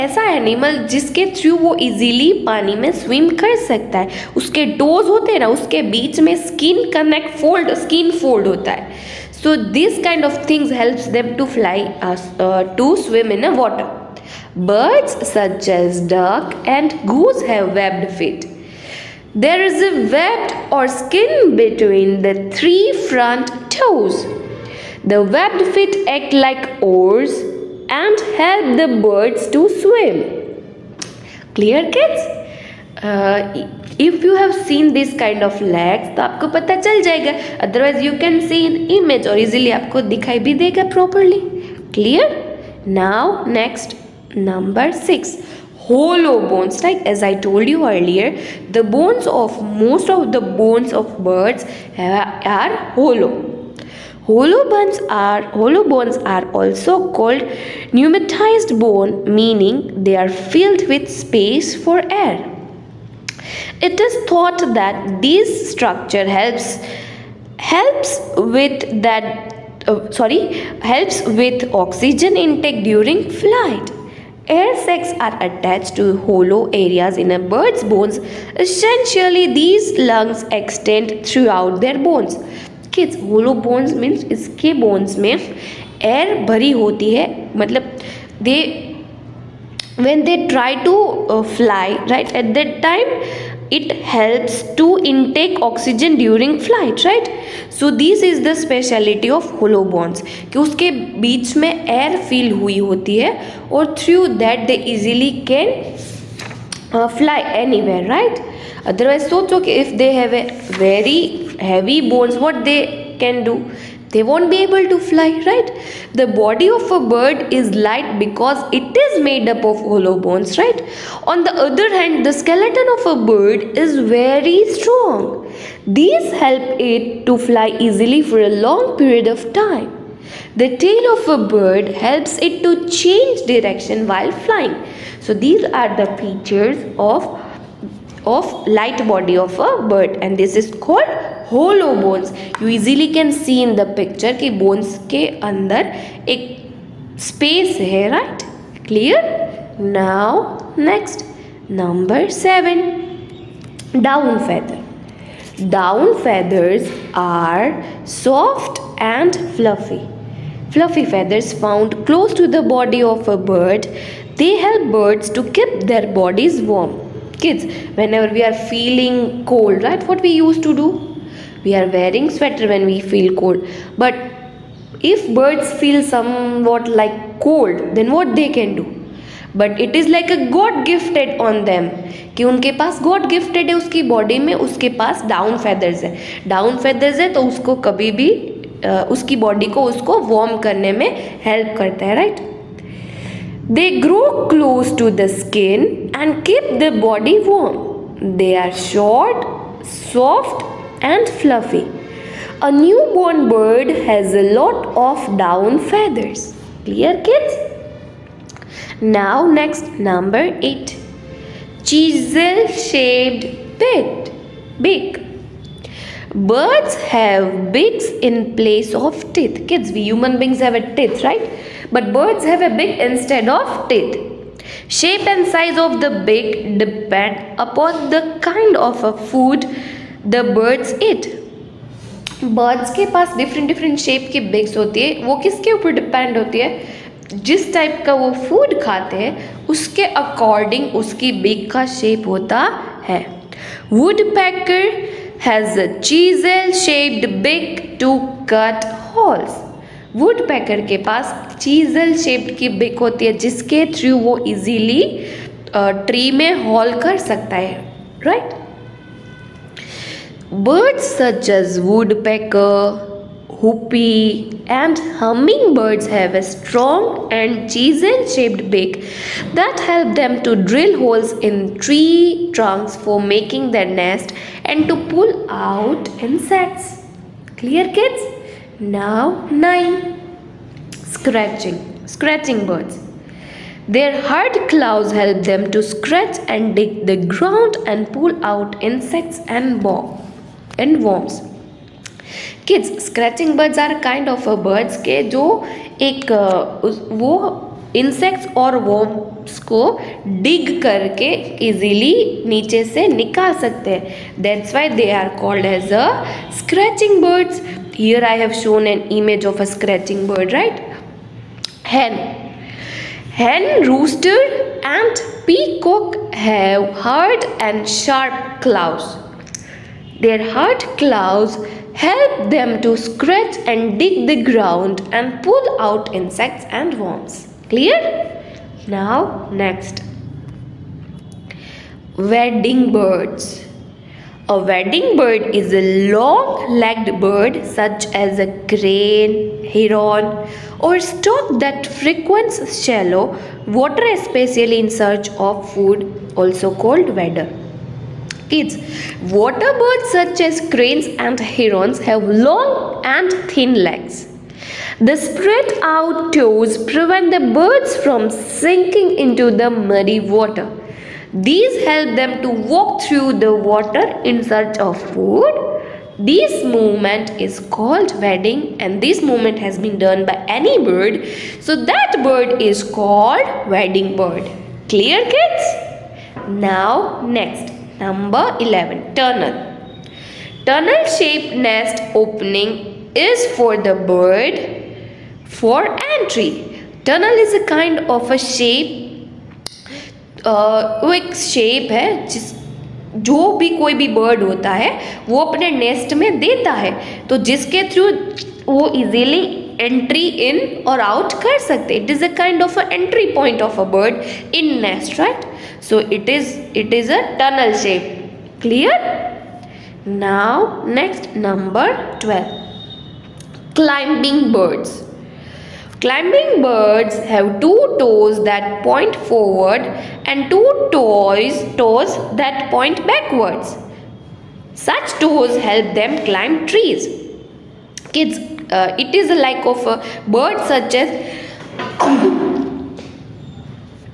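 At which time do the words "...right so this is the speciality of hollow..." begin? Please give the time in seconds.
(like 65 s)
97 s.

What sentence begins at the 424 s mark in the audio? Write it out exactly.
Such toes help them climb trees.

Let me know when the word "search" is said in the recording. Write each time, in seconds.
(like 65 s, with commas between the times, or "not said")
344 s, 364 s.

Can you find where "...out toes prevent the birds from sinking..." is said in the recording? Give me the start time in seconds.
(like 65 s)
355 s.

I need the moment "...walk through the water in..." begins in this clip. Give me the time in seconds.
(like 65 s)
362 s.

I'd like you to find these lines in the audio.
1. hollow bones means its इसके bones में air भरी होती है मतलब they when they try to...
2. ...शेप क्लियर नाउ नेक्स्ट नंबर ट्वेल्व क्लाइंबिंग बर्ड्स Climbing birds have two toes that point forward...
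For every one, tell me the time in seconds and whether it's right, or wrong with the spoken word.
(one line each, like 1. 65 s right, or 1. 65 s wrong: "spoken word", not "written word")
1. 82 s right
2. 407 s right.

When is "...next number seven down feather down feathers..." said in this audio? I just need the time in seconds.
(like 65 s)
150 s.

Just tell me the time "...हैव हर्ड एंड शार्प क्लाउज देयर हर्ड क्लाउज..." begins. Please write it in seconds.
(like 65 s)
316 s.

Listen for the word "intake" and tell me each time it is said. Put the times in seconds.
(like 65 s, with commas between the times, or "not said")
72 s, 95 s.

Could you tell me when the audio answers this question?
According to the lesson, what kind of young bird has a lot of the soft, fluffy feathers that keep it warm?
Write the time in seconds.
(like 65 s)
202 s.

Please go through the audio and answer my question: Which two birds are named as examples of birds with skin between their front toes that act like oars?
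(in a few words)
duck and goose.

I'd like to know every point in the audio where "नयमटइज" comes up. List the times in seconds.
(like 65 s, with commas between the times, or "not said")
57 s.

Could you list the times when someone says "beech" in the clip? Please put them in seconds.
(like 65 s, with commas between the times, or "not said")
101 s.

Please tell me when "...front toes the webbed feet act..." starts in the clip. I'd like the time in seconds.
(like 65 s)
23 s.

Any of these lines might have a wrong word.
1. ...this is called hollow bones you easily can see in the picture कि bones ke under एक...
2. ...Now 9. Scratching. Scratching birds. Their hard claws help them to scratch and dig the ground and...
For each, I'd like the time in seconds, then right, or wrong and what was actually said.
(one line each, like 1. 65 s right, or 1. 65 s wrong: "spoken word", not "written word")
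1. 140 s right
2. 278 s right.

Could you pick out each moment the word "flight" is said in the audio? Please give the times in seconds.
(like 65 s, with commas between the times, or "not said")
73 s, 96 s.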